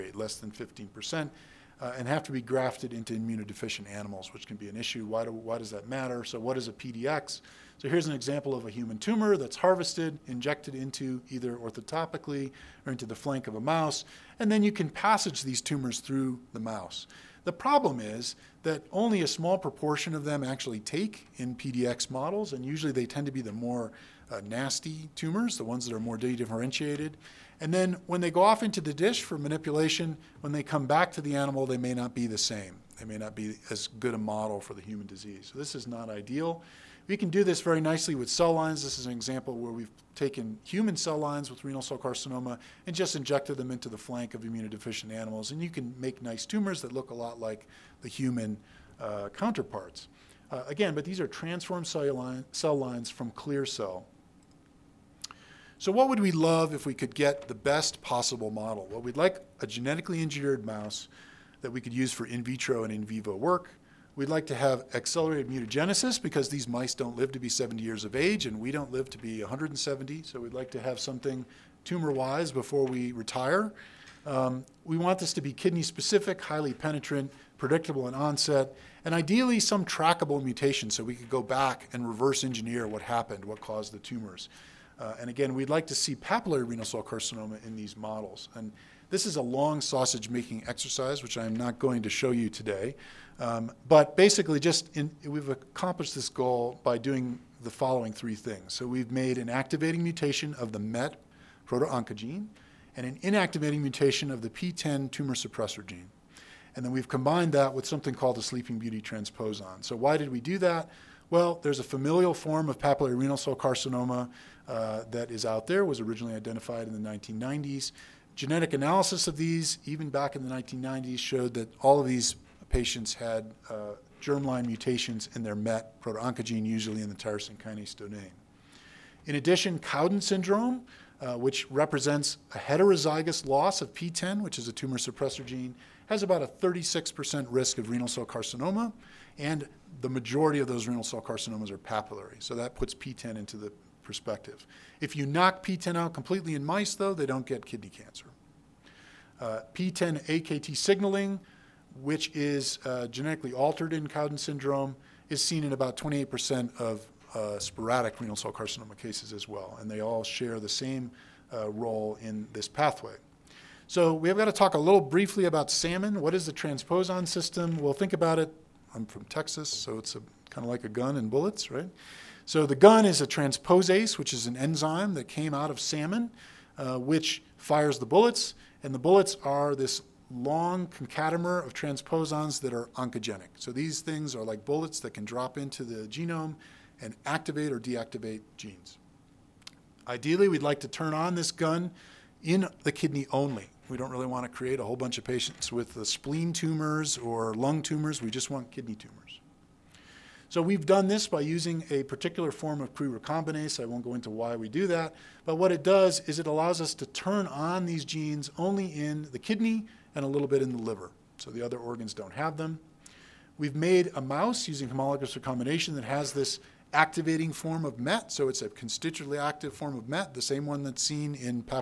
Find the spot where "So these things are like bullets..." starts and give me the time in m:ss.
3:03.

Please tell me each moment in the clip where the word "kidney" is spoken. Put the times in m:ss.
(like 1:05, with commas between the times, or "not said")
1:15, 2:27, 3:12, 3:18, 3:29.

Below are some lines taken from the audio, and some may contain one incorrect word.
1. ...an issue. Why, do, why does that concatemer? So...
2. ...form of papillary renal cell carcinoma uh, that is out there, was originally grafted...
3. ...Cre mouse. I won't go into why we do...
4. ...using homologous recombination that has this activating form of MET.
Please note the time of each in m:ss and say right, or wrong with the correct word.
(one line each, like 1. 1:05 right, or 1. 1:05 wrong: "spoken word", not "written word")
1. 0:04 wrong: "matter", not "concatemer"
2. 1:52 wrong: "identified", not "grafted"
3. 3:22 wrong: "recombinase", not "mouse"
4. 3:34 right.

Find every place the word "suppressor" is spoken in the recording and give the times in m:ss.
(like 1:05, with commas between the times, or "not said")
1:45, 2:14.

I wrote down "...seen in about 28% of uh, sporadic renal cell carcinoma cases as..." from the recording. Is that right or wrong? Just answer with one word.
right.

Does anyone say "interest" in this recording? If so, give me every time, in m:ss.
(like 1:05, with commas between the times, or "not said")
not said.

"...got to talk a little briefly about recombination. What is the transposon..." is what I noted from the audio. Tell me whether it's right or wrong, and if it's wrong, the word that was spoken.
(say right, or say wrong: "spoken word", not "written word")
wrong: "salmon", not "recombination".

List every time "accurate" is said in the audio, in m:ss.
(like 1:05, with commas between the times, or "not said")
not said.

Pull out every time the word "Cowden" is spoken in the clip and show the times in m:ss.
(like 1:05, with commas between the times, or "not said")
2:09, 2:34.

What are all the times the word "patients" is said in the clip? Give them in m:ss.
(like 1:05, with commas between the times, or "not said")
2:02, 3:15.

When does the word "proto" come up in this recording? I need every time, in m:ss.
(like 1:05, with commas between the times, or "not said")
1:41, 2:05.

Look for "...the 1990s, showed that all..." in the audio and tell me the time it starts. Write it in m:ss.
2:00.